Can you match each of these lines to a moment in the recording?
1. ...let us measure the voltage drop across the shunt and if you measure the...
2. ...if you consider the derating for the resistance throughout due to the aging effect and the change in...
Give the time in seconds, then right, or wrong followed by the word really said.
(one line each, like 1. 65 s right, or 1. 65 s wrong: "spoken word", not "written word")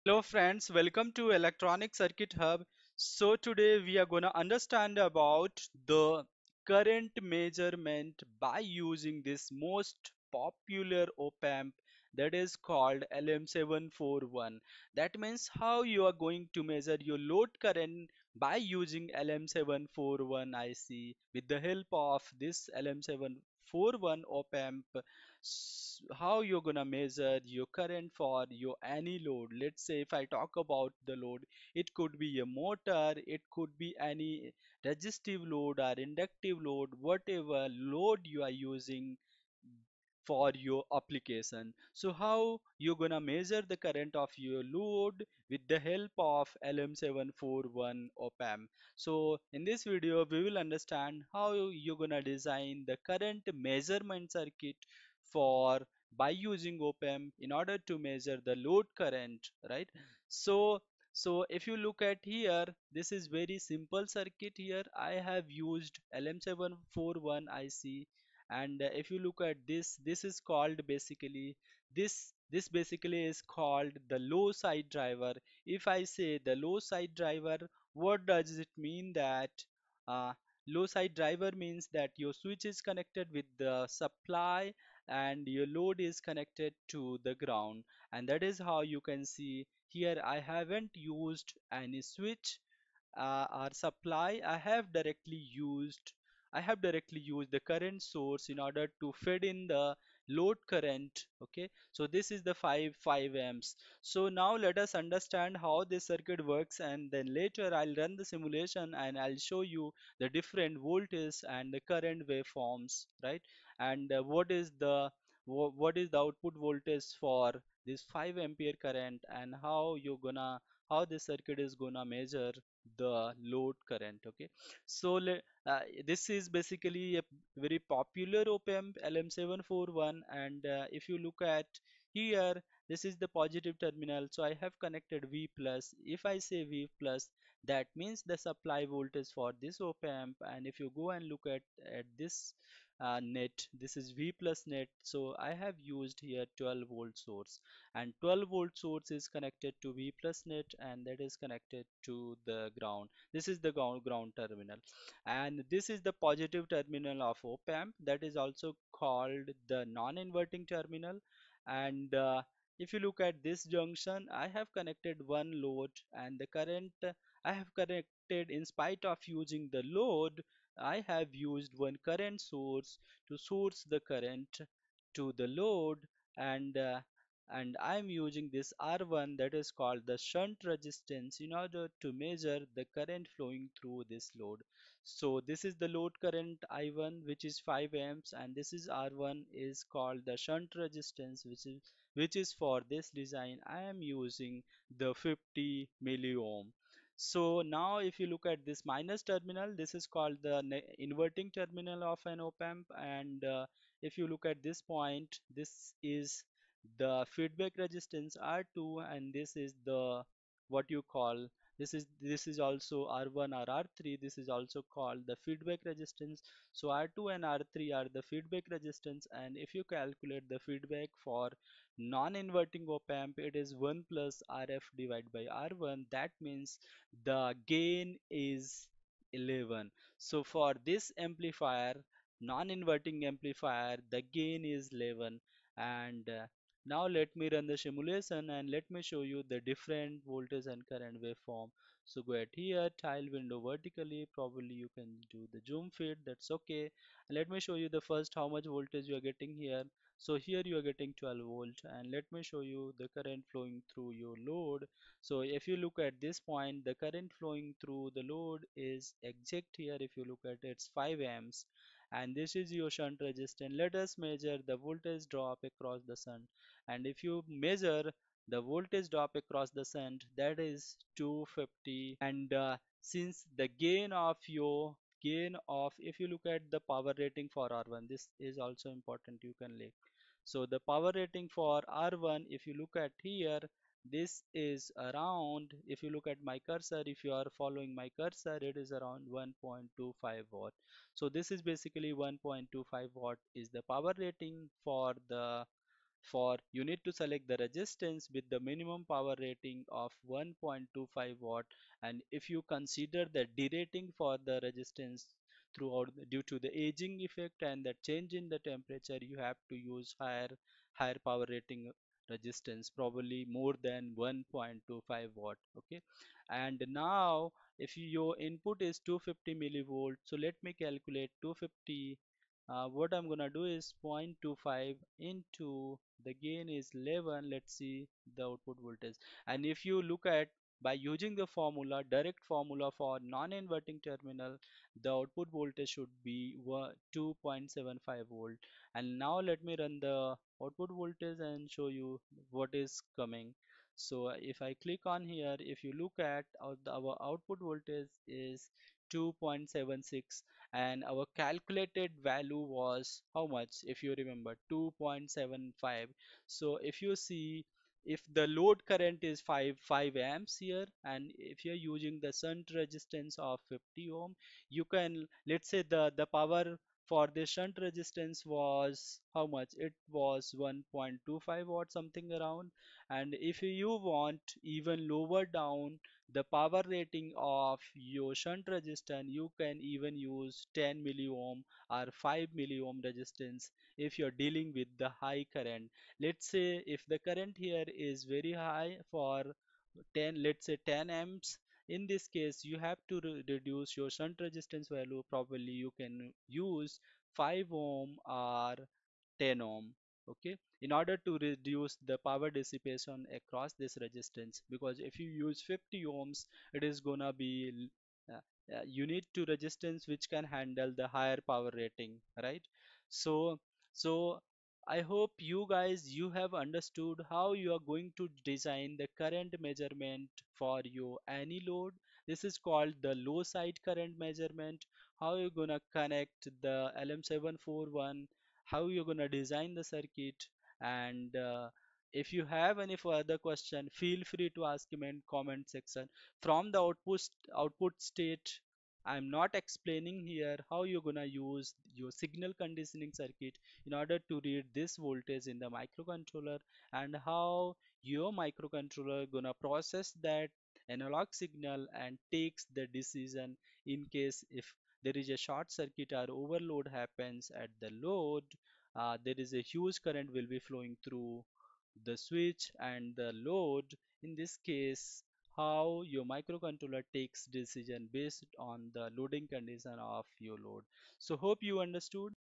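1. 263 s right
2. 302 s right.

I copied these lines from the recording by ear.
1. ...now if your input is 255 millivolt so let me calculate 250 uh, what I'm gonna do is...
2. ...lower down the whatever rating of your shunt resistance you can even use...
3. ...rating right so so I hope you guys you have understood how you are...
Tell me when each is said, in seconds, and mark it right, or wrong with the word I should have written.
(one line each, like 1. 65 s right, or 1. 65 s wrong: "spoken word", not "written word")
1. 316 s wrong: "250", not "255"
2. 375 s wrong: "power", not "whatever"
3. 411 s right.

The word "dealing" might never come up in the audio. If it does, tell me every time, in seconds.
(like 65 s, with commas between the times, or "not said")
384 s.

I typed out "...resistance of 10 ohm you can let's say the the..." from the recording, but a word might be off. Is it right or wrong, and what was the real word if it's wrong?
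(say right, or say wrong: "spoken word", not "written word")
wrong: "50", not "10".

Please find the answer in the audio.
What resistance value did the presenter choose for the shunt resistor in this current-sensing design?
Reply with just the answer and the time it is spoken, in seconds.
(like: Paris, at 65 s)
50 milliohm, at 195 s.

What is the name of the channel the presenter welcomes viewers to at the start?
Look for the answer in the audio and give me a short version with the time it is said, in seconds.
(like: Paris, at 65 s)
Electronic Circuit Hub, at 1 s.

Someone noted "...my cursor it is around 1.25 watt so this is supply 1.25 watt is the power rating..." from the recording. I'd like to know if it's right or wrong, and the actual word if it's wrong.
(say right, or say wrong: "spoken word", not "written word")
wrong: "basically", not "supply".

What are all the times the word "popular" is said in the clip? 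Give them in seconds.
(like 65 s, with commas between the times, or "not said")
10 s, 127 s.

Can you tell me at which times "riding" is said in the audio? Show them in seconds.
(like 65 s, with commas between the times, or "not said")
not said.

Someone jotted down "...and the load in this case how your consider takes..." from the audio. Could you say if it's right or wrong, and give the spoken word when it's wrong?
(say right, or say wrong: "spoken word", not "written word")
wrong: "microcontroller", not "consider".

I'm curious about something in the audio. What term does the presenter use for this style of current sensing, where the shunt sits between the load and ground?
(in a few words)
low side current measurement.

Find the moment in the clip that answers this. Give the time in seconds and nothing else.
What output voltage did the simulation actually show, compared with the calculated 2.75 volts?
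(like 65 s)
349 s.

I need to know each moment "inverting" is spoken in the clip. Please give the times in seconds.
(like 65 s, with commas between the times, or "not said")
159 s, 200 s, 221 s, 232 s, 333 s.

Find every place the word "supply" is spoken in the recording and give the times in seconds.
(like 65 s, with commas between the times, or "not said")
83 s, 93 s, 138 s.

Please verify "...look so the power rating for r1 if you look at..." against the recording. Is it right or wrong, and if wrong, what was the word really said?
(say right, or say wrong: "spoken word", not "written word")
right.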